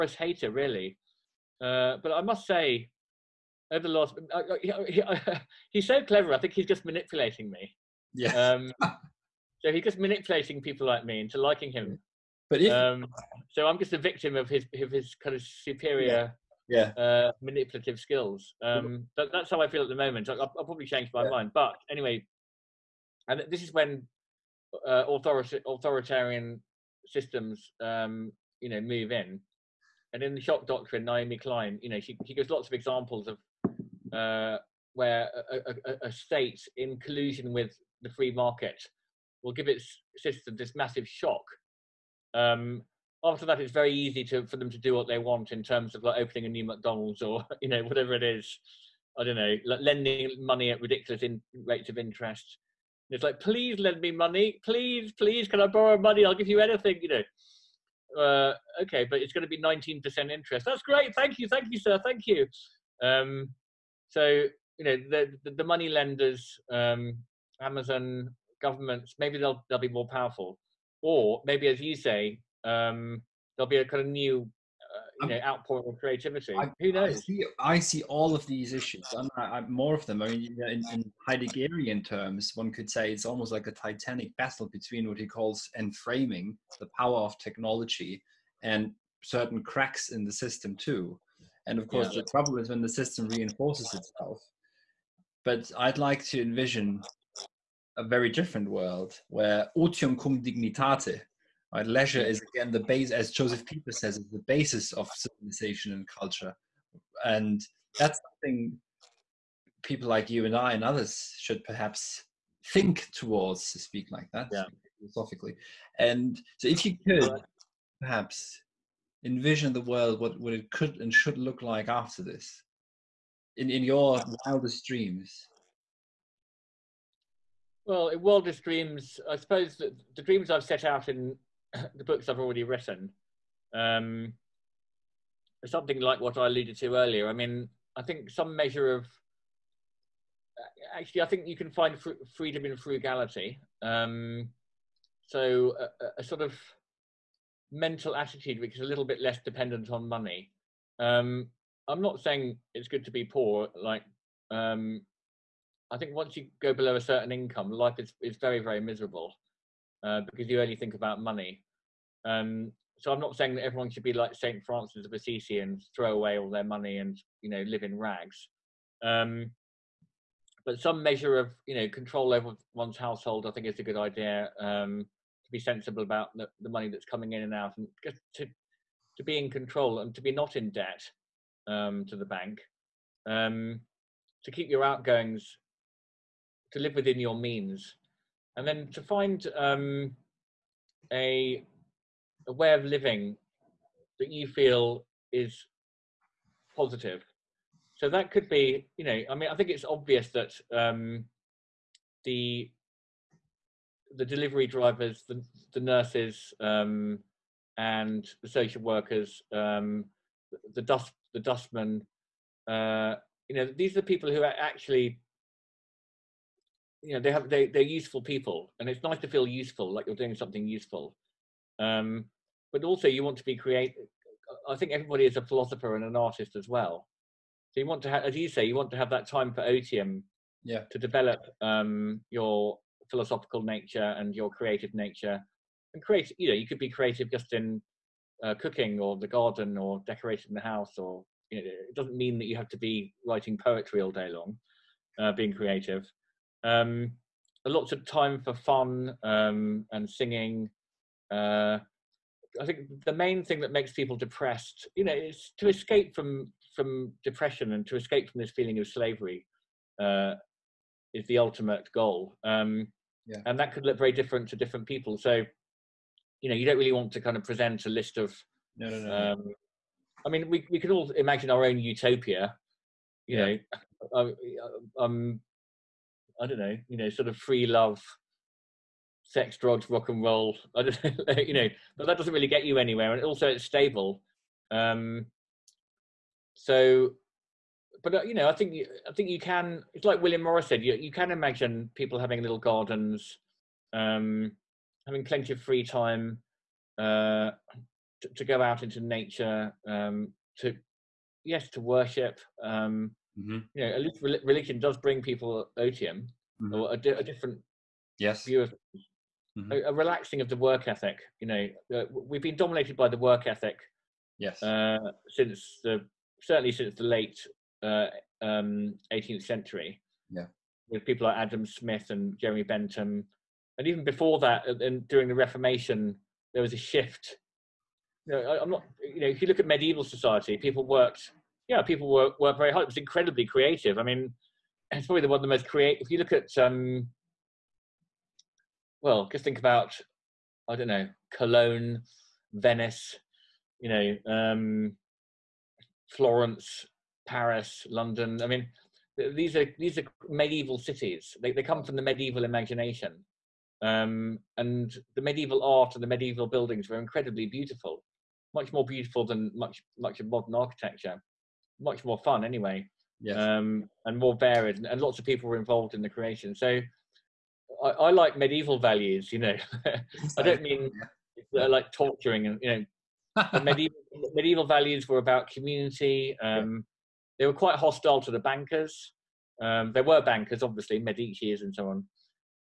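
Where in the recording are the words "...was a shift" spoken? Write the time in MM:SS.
05:26.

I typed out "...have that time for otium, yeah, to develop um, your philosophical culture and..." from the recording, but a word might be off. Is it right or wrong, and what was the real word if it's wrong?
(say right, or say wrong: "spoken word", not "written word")
wrong: "nature", not "culture".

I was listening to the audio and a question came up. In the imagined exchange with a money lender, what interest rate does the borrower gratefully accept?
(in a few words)
19%.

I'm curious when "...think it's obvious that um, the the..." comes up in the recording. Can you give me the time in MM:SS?
03:19.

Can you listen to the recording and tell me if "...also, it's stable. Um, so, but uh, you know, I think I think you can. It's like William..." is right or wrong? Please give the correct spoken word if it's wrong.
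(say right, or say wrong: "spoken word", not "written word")
right.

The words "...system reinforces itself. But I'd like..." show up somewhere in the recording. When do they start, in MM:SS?
01:32.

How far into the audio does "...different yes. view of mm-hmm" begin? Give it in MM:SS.
05:07.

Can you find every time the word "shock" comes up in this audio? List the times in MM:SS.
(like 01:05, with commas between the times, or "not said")
00:30, 00:41.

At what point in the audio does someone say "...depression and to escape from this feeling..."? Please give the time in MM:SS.
04:17.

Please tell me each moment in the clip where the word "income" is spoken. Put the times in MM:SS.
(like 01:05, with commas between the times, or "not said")
02:37.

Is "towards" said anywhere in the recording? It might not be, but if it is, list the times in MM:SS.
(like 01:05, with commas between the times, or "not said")
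01:53.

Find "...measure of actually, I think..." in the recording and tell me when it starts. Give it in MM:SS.
02:18.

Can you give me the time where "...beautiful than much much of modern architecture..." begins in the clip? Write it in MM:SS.
05:58.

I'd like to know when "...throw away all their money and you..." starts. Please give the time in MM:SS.
02:45.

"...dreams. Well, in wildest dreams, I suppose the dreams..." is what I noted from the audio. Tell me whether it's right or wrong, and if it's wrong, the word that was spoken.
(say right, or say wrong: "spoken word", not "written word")
right.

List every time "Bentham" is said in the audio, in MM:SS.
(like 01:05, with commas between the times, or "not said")
05:22.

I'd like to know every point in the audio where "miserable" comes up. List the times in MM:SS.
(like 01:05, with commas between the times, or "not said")
02:38.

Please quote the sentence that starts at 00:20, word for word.
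I, will probably change my yeah.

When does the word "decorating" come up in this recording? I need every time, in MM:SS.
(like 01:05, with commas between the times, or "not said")
04:00.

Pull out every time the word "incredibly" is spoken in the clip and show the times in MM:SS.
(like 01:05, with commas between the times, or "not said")
05:32, 05:56.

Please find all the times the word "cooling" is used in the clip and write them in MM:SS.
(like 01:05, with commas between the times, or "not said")
not said.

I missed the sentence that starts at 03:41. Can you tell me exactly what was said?
Um, but also, you want to be creative.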